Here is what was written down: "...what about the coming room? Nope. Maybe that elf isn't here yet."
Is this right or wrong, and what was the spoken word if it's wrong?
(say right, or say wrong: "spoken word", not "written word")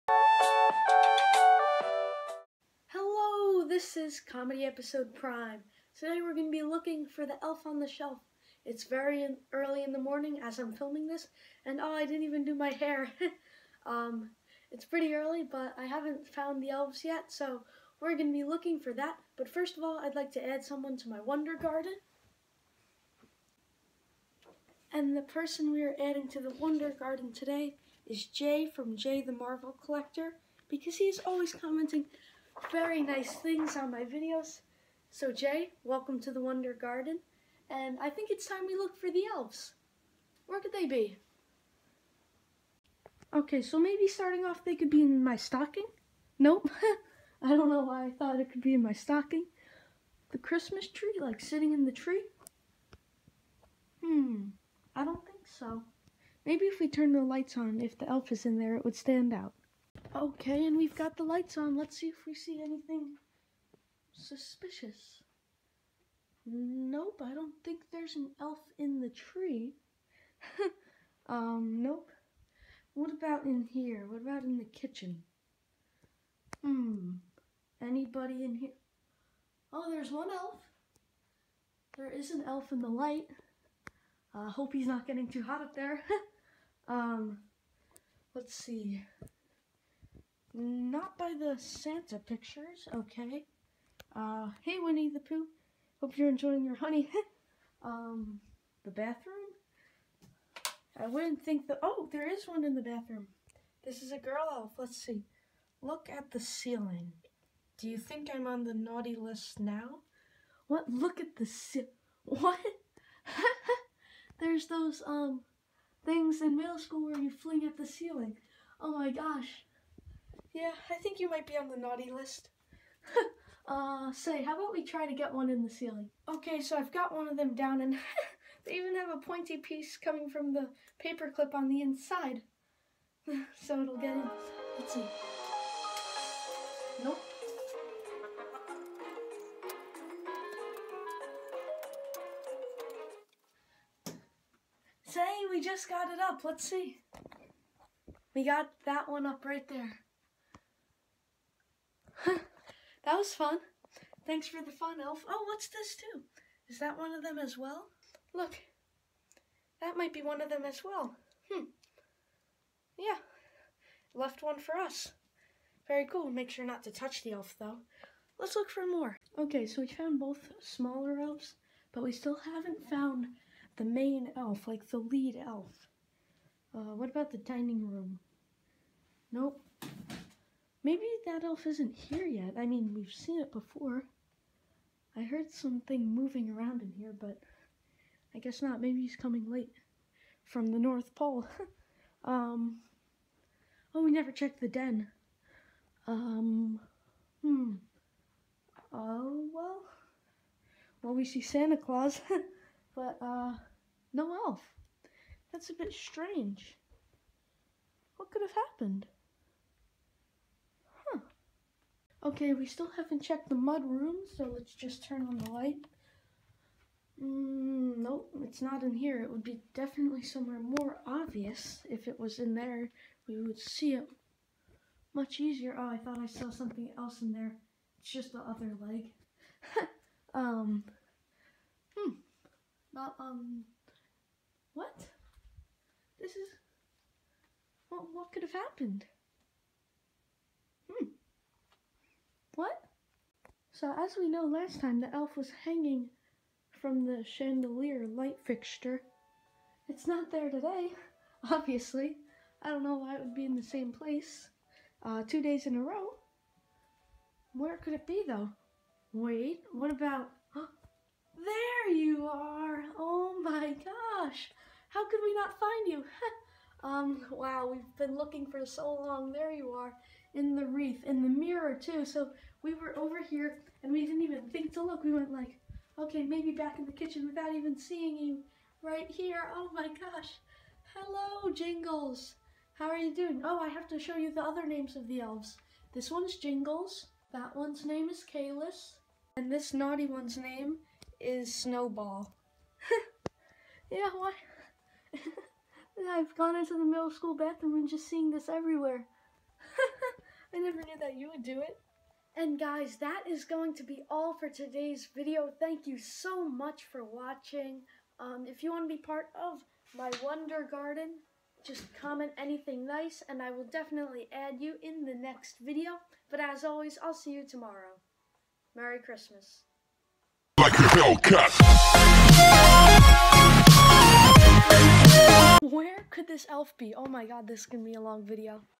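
wrong: "dining", not "coming".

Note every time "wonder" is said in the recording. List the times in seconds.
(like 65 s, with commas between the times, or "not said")
21 s, 26 s, 36 s, 310 s.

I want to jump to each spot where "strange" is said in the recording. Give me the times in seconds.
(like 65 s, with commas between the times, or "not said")
205 s.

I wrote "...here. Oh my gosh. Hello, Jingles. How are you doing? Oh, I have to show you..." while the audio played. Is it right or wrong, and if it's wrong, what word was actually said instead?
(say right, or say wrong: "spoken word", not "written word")
right.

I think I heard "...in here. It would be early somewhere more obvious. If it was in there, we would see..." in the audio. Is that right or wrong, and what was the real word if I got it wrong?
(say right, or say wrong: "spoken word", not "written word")
wrong: "definitely", not "early".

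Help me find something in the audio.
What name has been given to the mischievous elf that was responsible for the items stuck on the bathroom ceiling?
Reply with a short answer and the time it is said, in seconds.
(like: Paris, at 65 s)
Snowball, at 291 s.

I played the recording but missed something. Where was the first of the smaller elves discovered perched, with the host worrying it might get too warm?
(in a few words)
In the light.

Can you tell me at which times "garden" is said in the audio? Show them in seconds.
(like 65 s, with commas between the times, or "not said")
21 s, 26 s, 36 s, 310 s.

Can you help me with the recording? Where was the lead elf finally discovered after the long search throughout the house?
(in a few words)
In the wreath.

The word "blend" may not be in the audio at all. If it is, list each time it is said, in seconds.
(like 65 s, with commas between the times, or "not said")
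not said.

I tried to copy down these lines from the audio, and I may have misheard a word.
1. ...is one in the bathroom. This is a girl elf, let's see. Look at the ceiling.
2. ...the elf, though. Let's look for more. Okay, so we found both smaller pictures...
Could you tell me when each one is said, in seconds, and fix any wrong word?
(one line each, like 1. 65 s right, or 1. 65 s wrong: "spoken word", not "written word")
1. 102 s right
2. 167 s wrong: "elves", not "pictures".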